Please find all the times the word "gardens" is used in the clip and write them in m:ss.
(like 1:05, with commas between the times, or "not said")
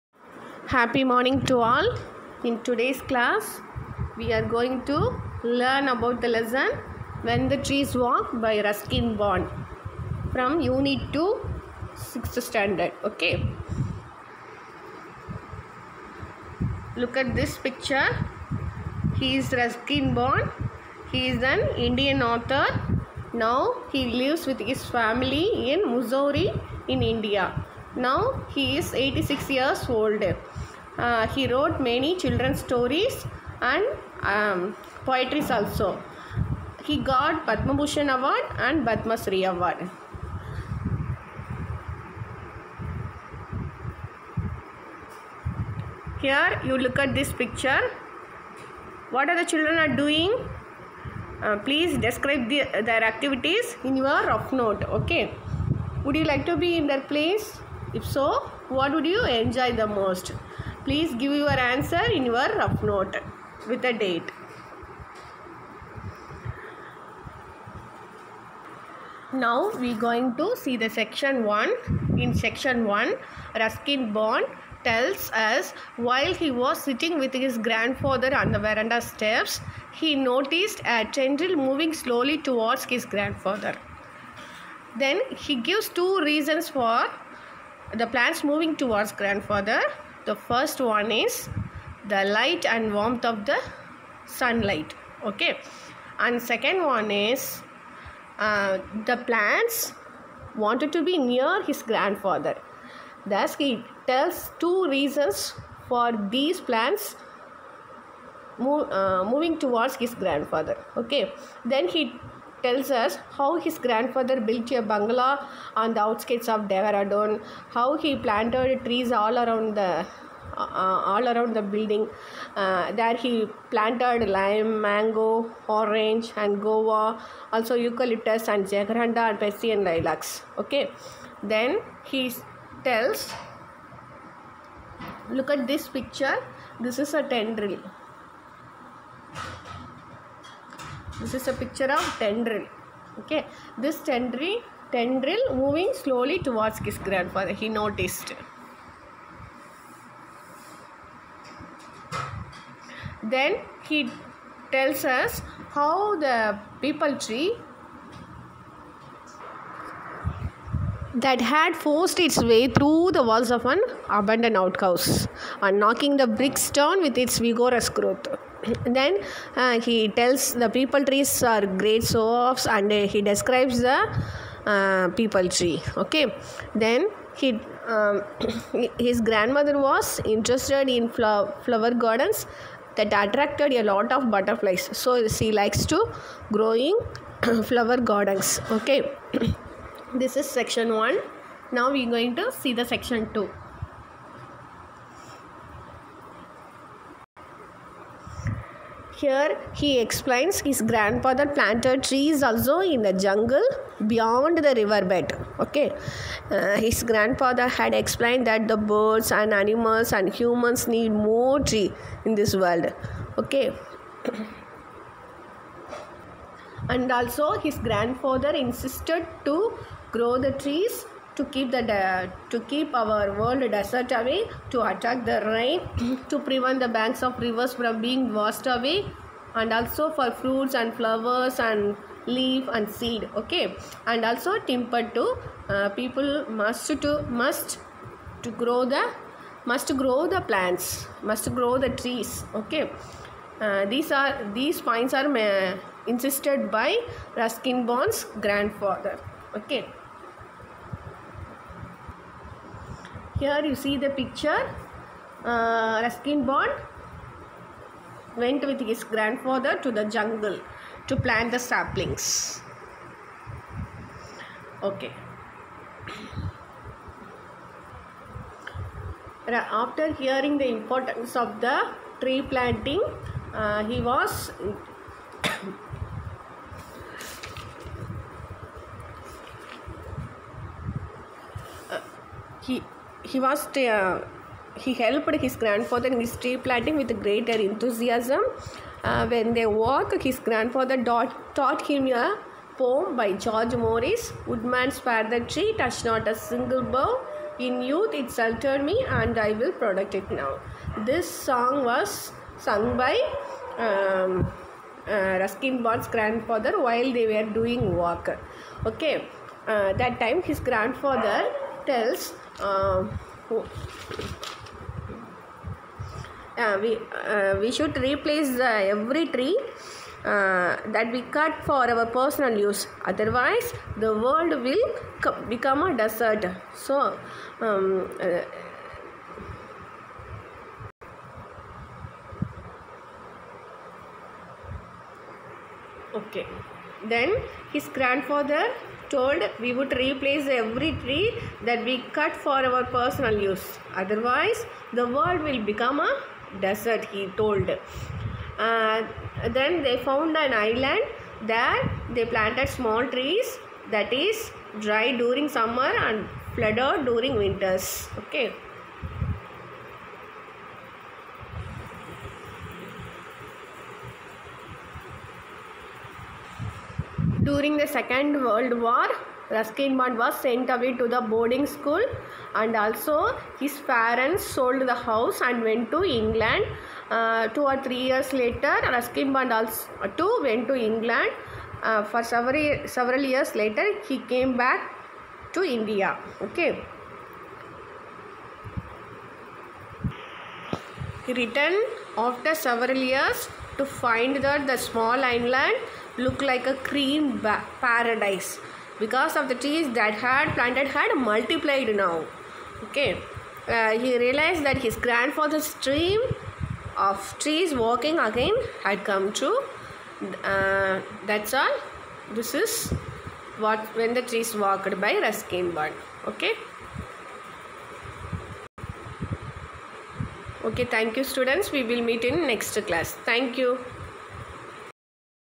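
3:01, 3:07.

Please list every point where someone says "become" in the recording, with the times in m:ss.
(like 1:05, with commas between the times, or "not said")
5:25, 5:45.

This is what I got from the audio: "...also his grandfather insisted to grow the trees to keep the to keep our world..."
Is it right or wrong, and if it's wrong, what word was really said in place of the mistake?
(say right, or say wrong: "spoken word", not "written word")
right.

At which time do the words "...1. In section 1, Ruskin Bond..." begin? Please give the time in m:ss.
1:11.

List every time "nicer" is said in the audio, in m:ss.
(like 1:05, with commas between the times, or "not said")
not said.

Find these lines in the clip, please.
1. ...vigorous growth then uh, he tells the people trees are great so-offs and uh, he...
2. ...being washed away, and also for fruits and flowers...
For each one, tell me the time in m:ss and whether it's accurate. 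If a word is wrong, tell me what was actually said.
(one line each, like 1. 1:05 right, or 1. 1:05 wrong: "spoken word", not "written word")
1. 2:47 right
2. 3:48 right.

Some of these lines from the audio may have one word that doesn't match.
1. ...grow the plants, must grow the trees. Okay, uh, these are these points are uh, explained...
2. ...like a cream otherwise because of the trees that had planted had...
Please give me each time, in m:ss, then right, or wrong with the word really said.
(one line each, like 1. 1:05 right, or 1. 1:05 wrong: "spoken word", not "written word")
1. 3:59 wrong: "insisted", not "explained"
2. 6:36 wrong: "paradise", not "otherwise".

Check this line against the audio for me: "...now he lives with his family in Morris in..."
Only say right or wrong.
wrong.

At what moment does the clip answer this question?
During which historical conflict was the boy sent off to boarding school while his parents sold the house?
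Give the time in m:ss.
6:07.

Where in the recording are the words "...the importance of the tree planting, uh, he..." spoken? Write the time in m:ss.
4:30.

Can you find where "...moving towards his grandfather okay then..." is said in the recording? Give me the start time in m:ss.
1:49.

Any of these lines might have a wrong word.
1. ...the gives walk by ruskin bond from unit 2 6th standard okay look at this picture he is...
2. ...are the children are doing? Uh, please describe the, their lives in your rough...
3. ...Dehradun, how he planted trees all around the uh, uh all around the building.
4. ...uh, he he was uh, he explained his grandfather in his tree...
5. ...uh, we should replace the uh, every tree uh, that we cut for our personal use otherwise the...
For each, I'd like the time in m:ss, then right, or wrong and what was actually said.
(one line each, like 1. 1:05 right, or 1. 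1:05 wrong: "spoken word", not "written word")
1. 0:07 wrong: "trees", not "gives"
2. 0:49 wrong: "activities", not "lives"
3. 1:56 right
4. 4:41 wrong: "helped", not "explained"
5. 5:17 right.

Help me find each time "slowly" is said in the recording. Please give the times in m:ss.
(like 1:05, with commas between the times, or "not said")
1:21, 2:25.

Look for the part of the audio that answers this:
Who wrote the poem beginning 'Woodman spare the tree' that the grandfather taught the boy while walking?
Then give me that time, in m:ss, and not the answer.
4:53.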